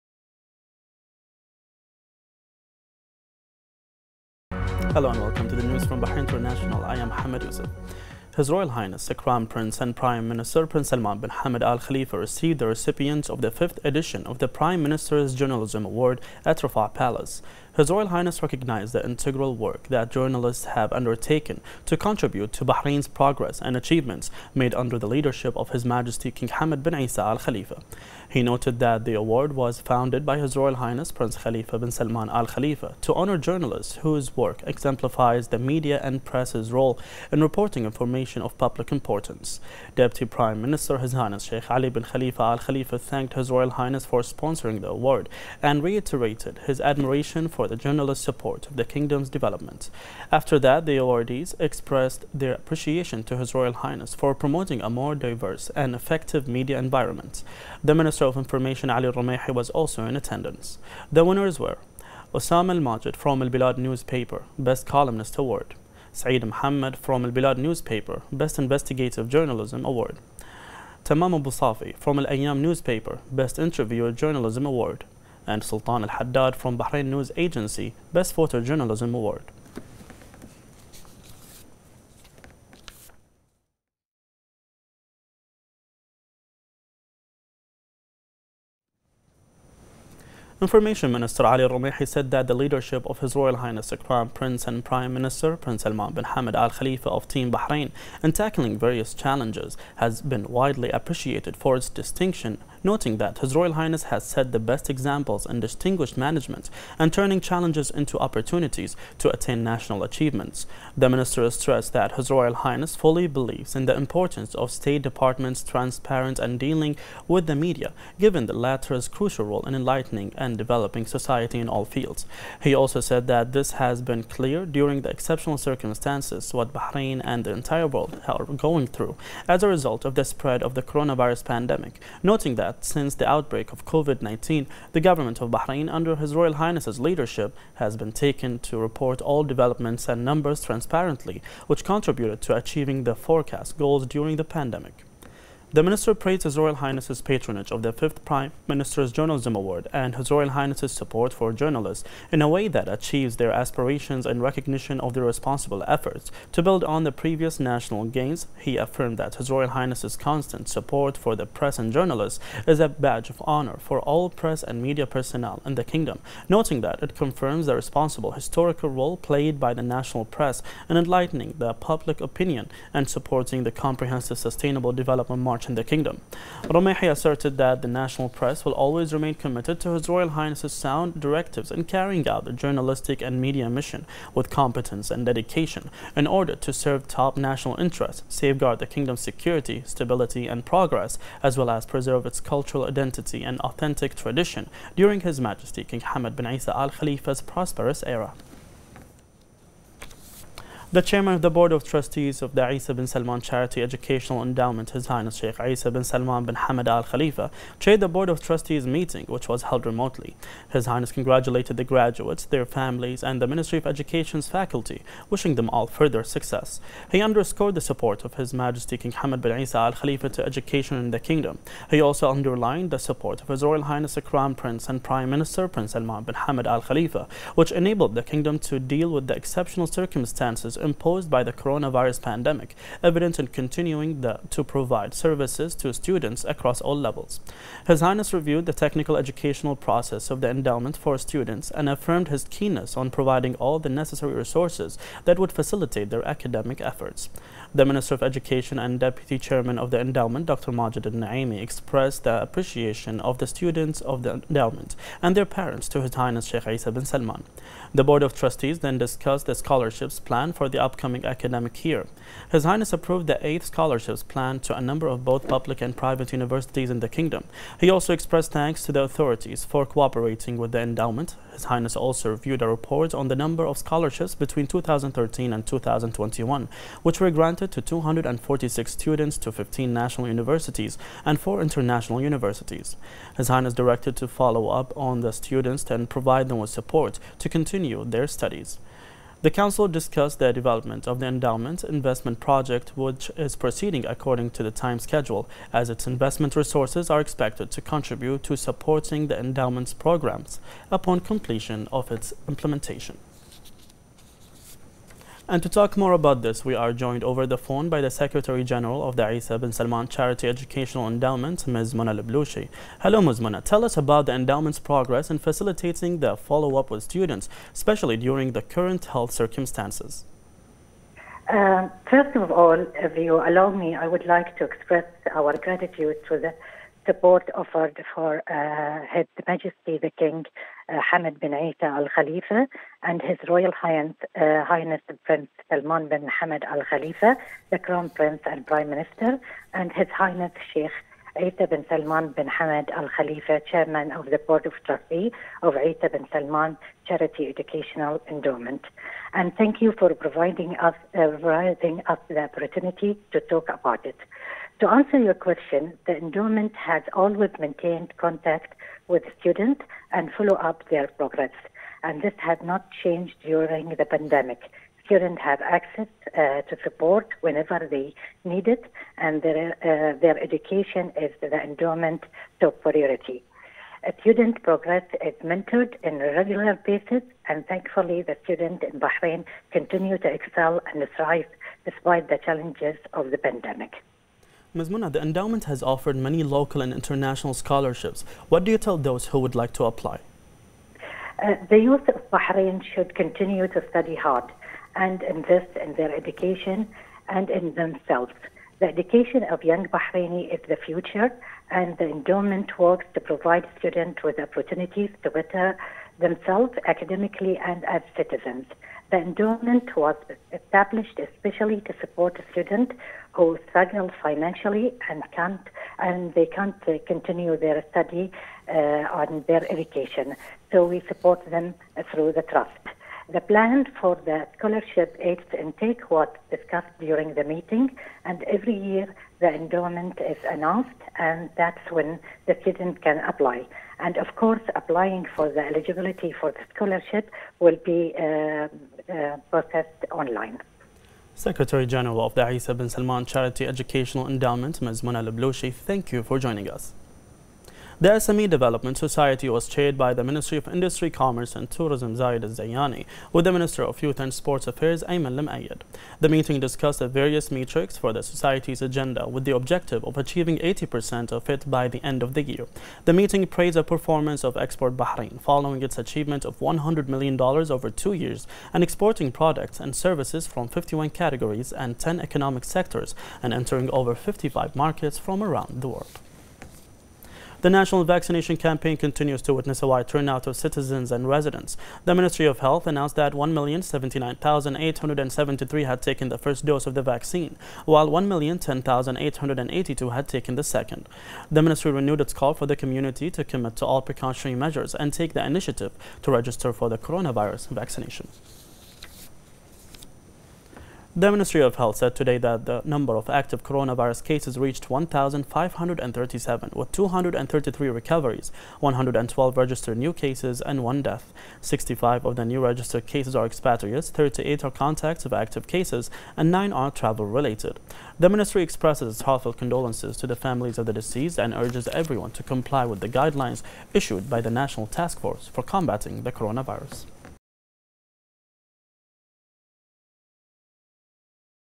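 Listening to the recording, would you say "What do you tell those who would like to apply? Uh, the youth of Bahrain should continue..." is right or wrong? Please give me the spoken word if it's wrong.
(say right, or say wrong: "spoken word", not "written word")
right.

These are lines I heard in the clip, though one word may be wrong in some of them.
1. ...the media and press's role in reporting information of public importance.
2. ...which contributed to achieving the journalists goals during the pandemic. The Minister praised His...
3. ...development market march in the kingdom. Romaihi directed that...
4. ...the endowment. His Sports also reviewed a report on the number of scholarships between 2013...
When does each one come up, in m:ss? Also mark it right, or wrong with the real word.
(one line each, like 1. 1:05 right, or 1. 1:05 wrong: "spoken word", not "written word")
1. 0:35 right
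2. 2:21 wrong: "forecast", not "journalists"
3. 2:54 wrong: "asserted", not "directed"
4. 4:30 wrong: "Highness", not "Sports".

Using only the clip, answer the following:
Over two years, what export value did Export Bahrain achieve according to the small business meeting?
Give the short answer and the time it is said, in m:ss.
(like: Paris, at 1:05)
$100 million, at 7:46.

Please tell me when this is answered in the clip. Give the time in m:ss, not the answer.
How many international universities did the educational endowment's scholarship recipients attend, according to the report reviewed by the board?
4:41.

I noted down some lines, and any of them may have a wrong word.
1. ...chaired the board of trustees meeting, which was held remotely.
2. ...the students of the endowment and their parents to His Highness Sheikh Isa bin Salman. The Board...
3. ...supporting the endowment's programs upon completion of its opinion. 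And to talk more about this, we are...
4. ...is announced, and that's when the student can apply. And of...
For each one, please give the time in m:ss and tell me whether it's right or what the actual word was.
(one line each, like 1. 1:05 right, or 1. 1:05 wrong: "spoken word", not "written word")
1. 3:27 right
2. 4:13 right
3. 4:58 wrong: "implementation", not "opinion"
4. 7:10 right.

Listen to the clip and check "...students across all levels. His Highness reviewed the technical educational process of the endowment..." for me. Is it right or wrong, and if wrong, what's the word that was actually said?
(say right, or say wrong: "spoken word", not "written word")
right.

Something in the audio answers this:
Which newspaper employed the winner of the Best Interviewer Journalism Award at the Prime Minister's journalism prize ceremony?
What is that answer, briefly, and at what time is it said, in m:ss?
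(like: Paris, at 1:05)
Al-Ayyam, at 1:12.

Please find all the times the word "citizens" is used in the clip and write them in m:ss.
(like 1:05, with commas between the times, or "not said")
6:48, 8:00.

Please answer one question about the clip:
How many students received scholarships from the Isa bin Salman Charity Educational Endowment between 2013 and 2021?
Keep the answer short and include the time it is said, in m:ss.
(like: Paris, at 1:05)
246, at 4:37.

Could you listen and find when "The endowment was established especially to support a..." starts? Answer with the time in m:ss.
6:49.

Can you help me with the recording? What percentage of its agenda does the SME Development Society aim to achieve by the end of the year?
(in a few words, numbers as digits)
80%.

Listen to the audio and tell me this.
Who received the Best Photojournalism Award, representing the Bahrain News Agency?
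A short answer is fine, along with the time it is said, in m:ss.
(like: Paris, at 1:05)
Sultan Al-Haddad, at 1:15.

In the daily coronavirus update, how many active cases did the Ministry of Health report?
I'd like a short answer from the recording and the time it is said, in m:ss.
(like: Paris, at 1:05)
1,537, at 8:24.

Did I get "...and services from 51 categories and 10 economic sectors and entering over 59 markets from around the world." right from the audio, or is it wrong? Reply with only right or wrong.
wrong.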